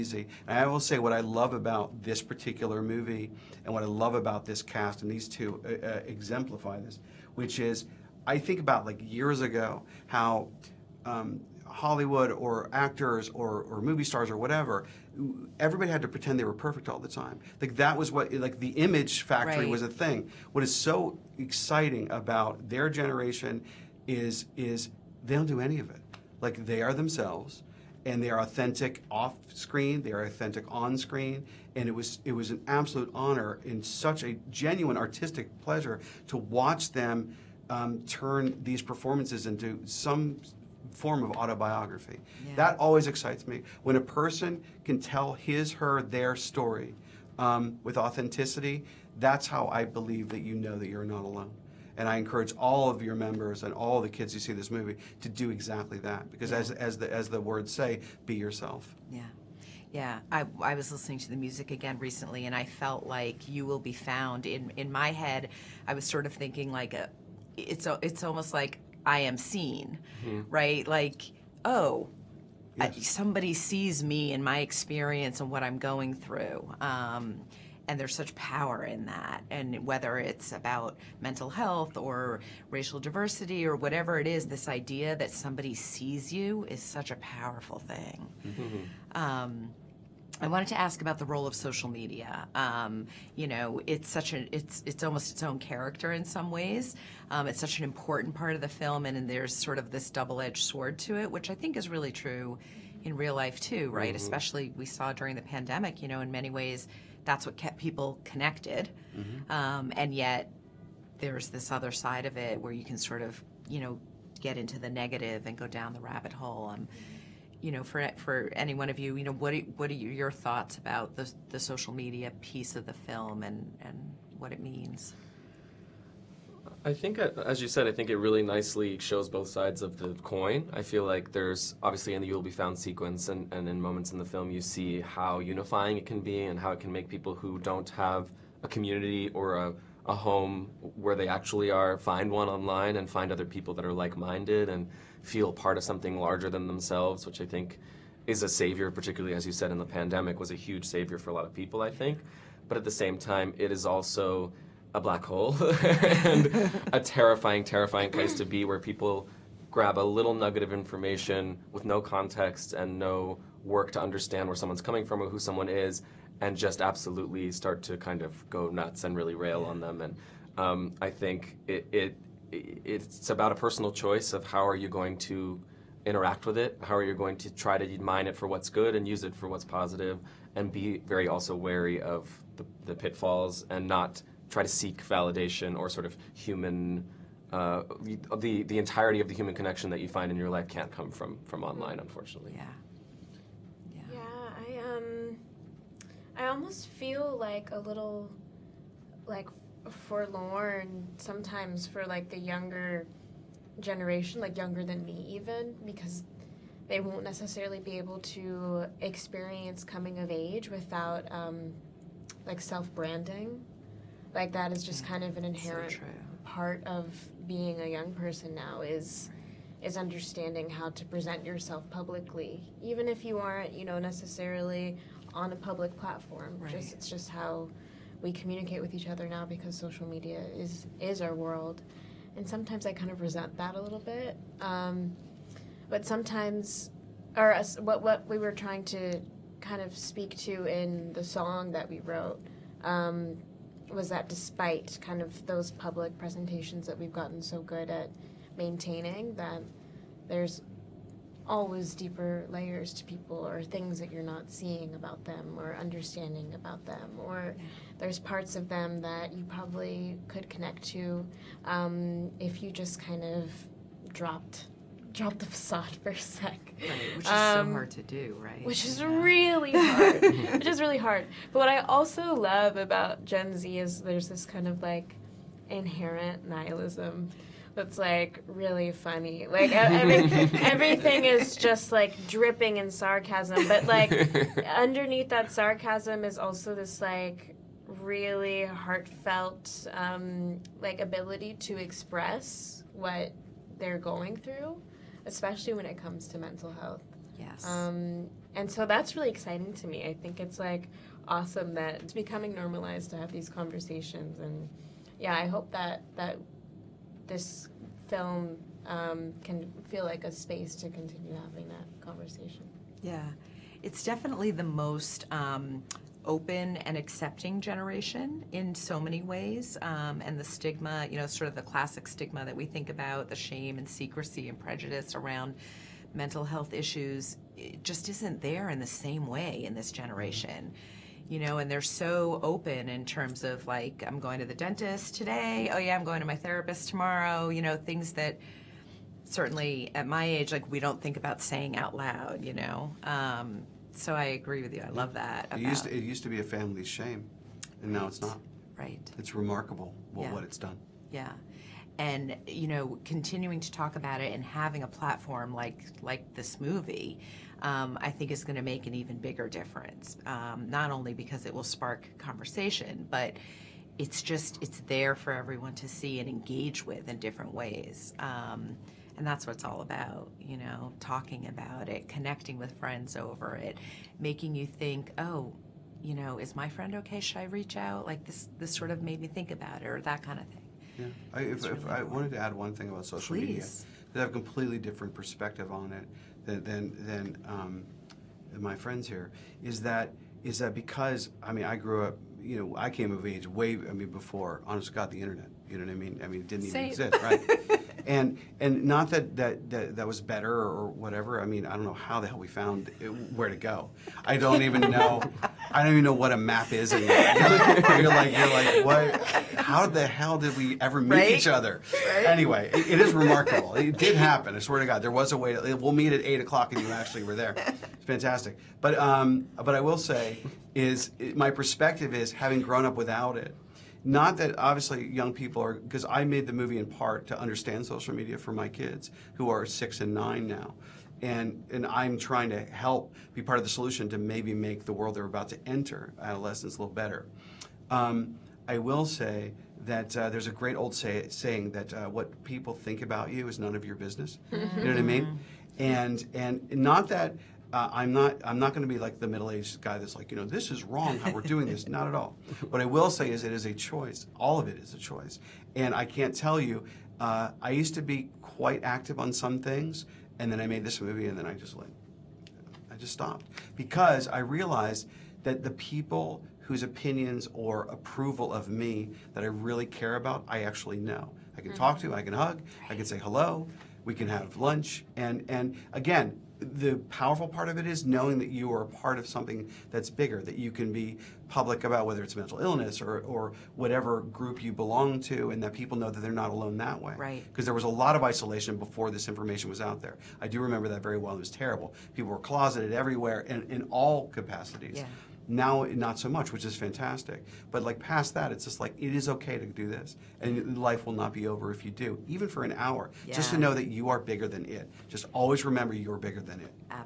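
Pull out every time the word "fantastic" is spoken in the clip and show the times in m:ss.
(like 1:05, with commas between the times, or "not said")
6:58, 8:16.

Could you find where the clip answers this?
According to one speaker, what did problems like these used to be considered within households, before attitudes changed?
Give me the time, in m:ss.
5:46.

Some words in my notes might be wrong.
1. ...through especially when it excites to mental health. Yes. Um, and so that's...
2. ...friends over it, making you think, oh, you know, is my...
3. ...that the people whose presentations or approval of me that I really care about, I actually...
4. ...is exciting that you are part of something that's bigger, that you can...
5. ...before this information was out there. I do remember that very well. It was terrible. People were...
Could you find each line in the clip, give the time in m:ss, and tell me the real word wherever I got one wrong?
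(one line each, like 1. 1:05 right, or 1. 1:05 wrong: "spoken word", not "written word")
1. 4:54 wrong: "comes", not "excites"
2. 6:12 right
3. 7:45 wrong: "opinions", not "presentations"
4. 7:57 wrong: "knowing", not "exciting"
5. 8:08 right.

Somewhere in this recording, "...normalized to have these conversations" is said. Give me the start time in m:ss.
5:02.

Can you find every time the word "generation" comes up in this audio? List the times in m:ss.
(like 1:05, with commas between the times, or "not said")
0:22, 3:23, 5:17, 5:30.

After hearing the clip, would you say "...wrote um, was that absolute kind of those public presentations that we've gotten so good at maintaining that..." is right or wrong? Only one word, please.
wrong.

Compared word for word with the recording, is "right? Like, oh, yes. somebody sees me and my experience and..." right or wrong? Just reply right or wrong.
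right.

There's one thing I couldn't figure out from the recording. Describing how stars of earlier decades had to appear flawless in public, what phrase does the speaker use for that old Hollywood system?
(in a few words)
image factory.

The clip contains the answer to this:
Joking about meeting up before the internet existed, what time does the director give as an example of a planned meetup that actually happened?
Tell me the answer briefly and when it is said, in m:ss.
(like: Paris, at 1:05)
8 o'clock, at 6:56.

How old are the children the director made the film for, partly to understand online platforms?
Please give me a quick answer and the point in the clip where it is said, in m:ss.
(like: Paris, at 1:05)
6 and 9, at 7:09.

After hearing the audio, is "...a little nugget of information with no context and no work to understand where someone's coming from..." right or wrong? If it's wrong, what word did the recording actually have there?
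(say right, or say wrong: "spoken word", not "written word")
right.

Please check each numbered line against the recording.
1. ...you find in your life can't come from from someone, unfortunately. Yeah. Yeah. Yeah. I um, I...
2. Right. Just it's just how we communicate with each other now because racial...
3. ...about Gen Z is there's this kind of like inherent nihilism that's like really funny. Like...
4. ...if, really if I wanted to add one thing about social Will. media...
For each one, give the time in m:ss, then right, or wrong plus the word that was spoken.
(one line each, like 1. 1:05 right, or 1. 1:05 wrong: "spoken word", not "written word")
1. 3:10 wrong: "online", not "someone"
2. 3:46 wrong: "social", not "racial"
3. 4:32 right
4. 6:21 wrong: "Please", not "Will".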